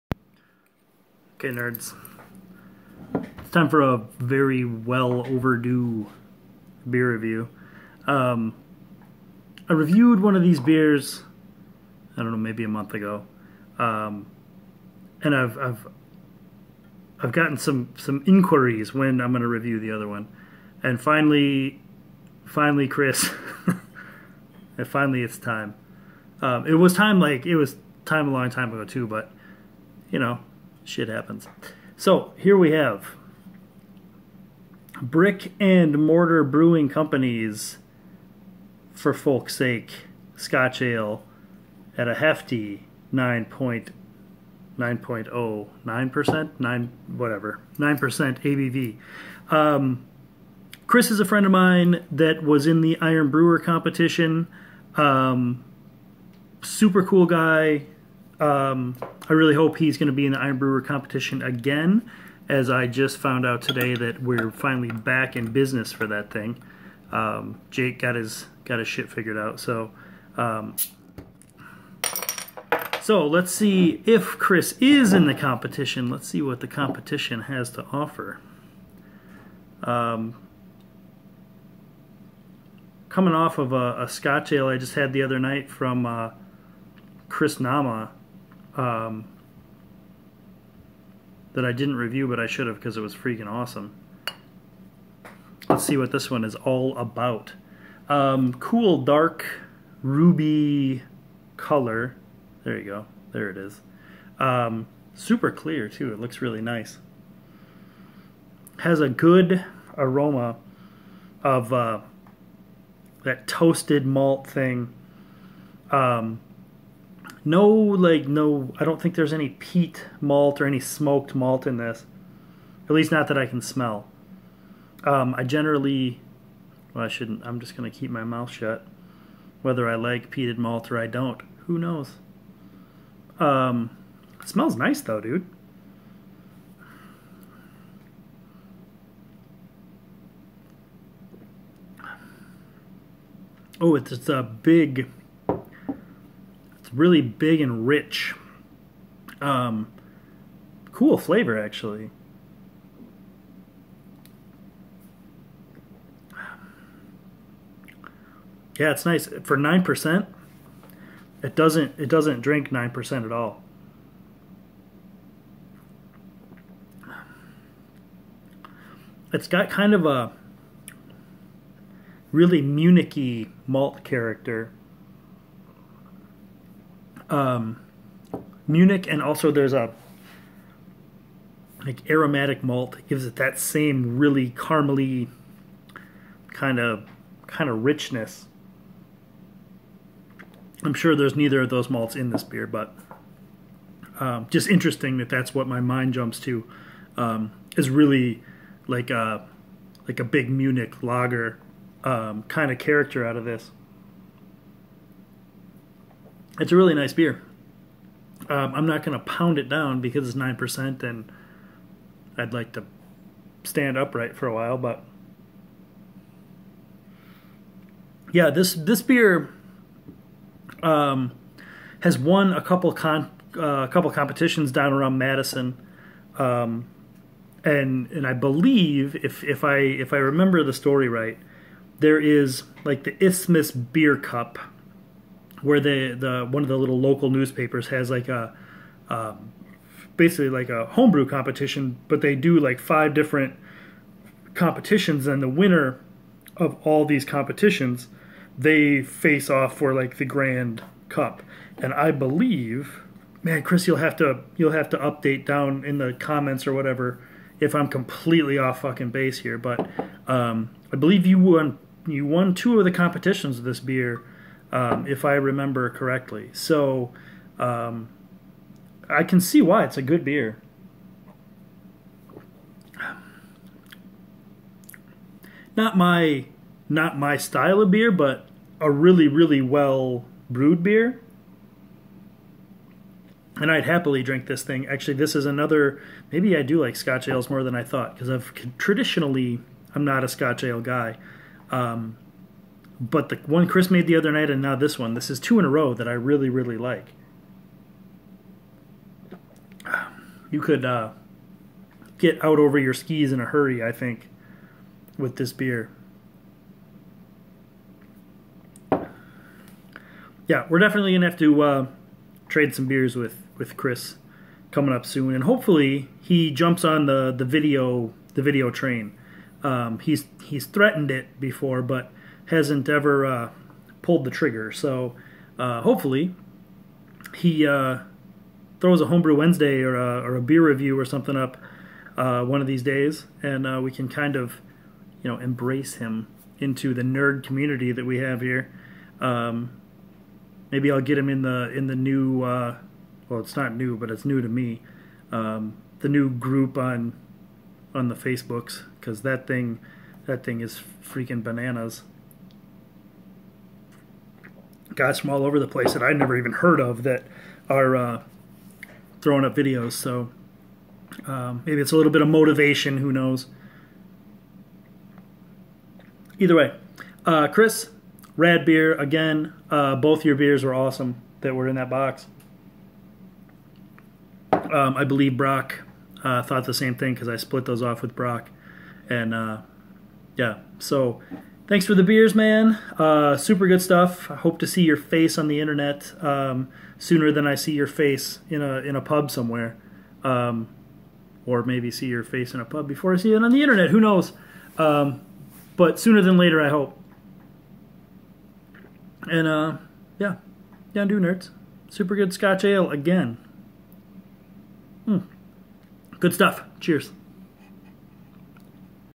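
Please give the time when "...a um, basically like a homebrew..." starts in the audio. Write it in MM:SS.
03:58.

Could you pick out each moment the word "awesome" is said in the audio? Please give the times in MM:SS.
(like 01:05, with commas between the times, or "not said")
01:33, 06:10.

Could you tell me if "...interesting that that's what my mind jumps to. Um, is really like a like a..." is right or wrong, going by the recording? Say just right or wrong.
right.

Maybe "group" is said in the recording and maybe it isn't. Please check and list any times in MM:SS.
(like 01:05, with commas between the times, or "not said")
05:46.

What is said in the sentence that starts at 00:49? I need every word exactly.
Um, Chris is a friend of mine that was in the Iron Brewer competition.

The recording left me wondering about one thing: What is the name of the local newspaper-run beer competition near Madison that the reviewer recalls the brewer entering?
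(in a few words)
Isthmus Beer Cup.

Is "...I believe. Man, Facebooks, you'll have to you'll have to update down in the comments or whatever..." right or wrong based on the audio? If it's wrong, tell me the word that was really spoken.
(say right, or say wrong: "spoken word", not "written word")
wrong: "Chris", not "Facebooks".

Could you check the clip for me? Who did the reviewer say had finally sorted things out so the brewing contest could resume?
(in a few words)
Jake.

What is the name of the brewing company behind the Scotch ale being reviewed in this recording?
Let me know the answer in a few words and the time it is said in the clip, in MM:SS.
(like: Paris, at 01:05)
Brick and Mortar Brewing, at 00:35.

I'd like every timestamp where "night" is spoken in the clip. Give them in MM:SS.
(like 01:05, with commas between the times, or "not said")
01:25, 04:54.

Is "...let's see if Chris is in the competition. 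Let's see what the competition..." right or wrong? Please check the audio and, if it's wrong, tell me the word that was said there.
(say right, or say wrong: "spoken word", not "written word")
right.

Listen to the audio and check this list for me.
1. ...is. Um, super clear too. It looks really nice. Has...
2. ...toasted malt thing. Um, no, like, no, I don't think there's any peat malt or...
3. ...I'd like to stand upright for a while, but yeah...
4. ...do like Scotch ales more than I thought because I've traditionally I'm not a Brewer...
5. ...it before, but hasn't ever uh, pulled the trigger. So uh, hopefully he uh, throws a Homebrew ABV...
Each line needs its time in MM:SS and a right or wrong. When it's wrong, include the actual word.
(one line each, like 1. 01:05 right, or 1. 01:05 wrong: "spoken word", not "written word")
1. 01:43 right
2. 01:53 right
3. 03:32 right
4. 04:46 wrong: "Scotch", not "Brewer"
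5. 05:21 wrong: "Wednesday", not "ABV".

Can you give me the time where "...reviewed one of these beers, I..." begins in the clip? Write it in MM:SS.
00:09.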